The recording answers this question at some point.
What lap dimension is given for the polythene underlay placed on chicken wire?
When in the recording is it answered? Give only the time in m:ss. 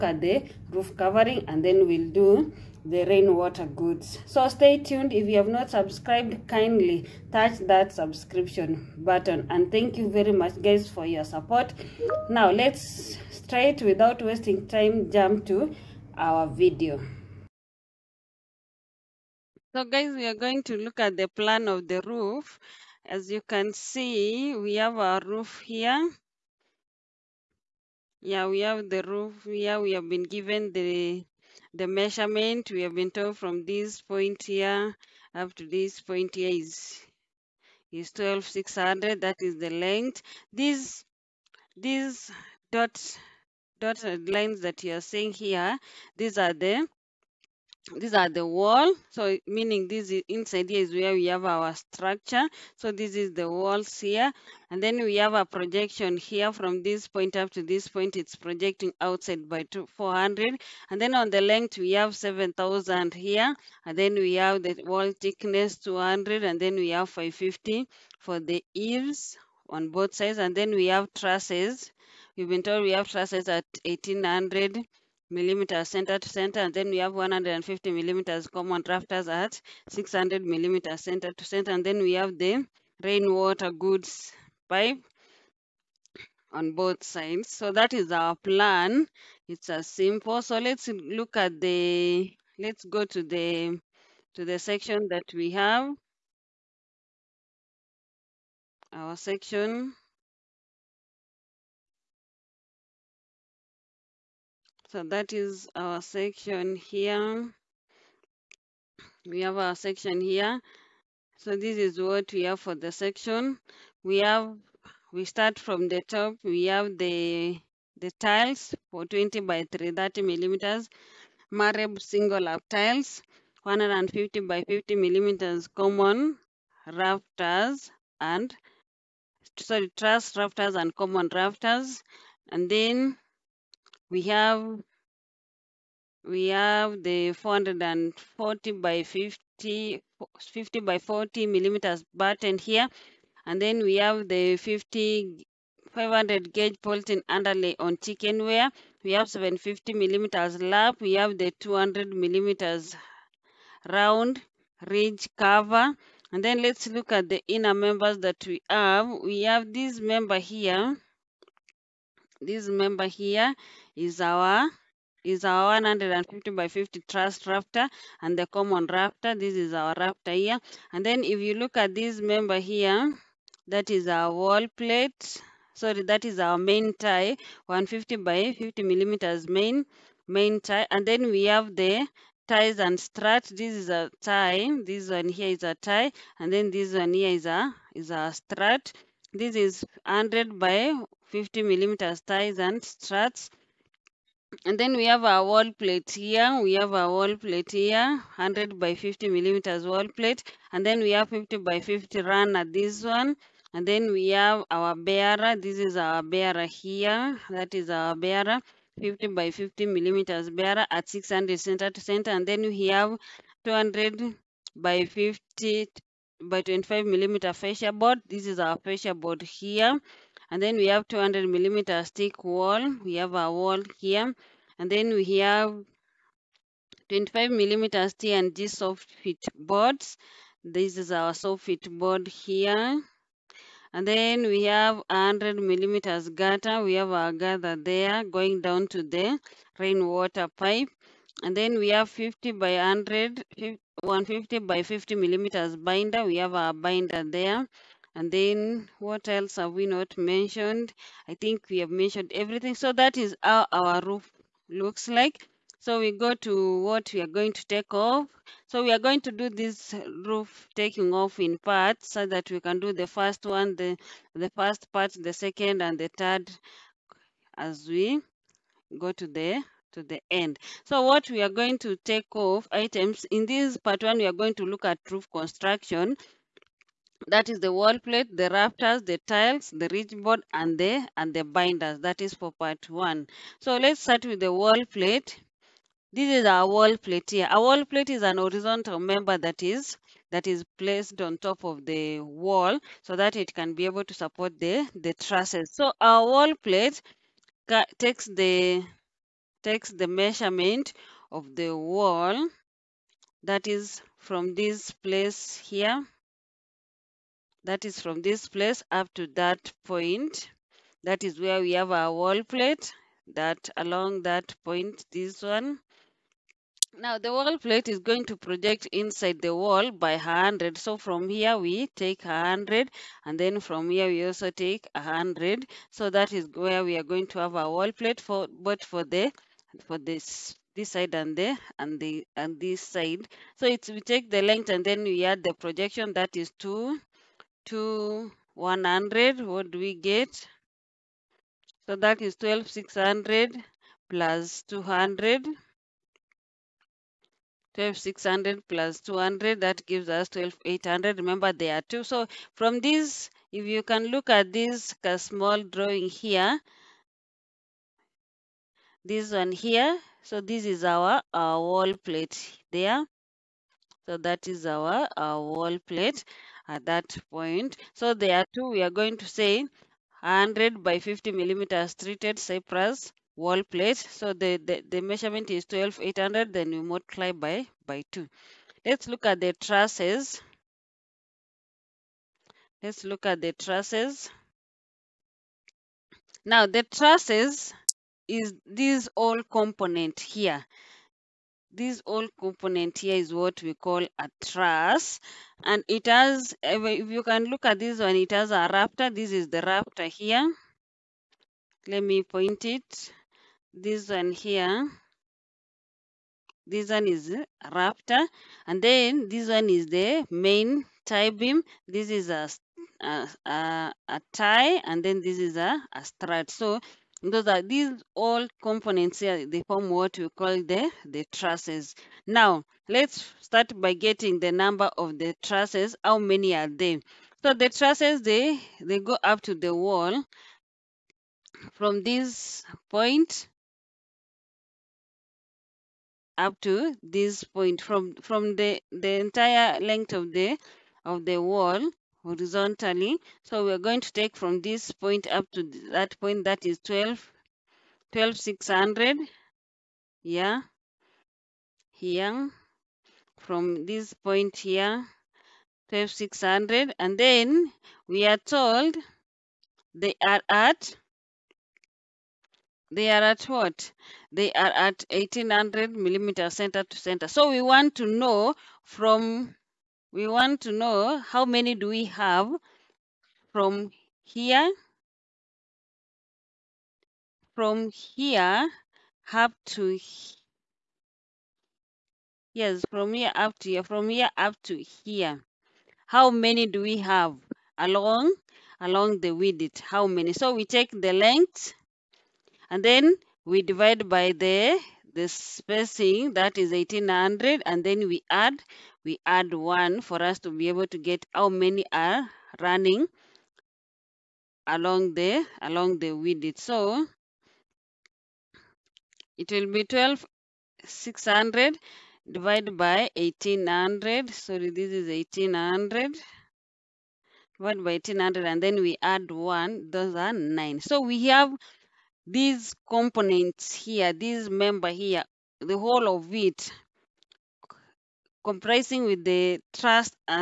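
2:29.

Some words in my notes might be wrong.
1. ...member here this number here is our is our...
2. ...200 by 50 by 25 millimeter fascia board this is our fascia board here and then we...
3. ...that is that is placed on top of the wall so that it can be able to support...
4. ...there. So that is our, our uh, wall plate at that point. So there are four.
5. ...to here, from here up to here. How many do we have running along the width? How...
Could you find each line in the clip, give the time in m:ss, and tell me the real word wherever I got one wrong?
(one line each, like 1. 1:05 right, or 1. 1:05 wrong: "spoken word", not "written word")
1. 2:39 wrong: "member", not "number"
2. 3:33 right
3. 4:49 right
4. 6:02 wrong: "two", not "four"
5. 8:03 wrong: "along", not "running".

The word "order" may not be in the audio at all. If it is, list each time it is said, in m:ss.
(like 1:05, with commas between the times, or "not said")
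not said.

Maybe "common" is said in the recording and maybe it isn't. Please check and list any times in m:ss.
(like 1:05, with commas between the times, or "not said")
1:18, 2:05, 2:10, 2:48.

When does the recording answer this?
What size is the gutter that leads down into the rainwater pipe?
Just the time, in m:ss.
3:55.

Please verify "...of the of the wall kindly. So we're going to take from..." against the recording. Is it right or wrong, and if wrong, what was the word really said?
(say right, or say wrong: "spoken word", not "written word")
wrong: "horizontally", not "kindly".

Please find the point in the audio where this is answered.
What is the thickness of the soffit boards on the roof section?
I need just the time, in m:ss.
3:47.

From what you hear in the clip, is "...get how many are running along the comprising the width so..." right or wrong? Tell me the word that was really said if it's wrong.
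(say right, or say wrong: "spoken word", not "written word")
wrong: "along", not "comprising".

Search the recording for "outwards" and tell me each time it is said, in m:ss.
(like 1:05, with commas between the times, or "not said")
not said.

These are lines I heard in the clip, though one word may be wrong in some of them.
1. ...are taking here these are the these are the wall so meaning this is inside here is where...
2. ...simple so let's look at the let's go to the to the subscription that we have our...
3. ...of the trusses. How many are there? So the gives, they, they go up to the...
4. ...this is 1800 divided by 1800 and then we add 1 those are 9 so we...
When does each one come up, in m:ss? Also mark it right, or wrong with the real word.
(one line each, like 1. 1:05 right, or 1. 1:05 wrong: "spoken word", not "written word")
1. 0:44 wrong: "seeing", not "taking"
2. 1:29 wrong: "section", not "subscription"
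3. 7:04 wrong: "trusses", not "gives"
4. 8:34 right.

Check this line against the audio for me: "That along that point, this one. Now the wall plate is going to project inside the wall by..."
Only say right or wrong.
right.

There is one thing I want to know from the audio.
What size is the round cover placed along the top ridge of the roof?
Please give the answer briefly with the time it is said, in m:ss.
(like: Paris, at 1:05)
200 millimeters, at 2:31.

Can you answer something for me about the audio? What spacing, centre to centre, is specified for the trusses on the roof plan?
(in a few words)
1800 millimeters.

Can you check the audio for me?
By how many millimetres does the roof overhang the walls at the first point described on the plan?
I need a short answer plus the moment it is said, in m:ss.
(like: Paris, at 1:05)
400, at 0:59.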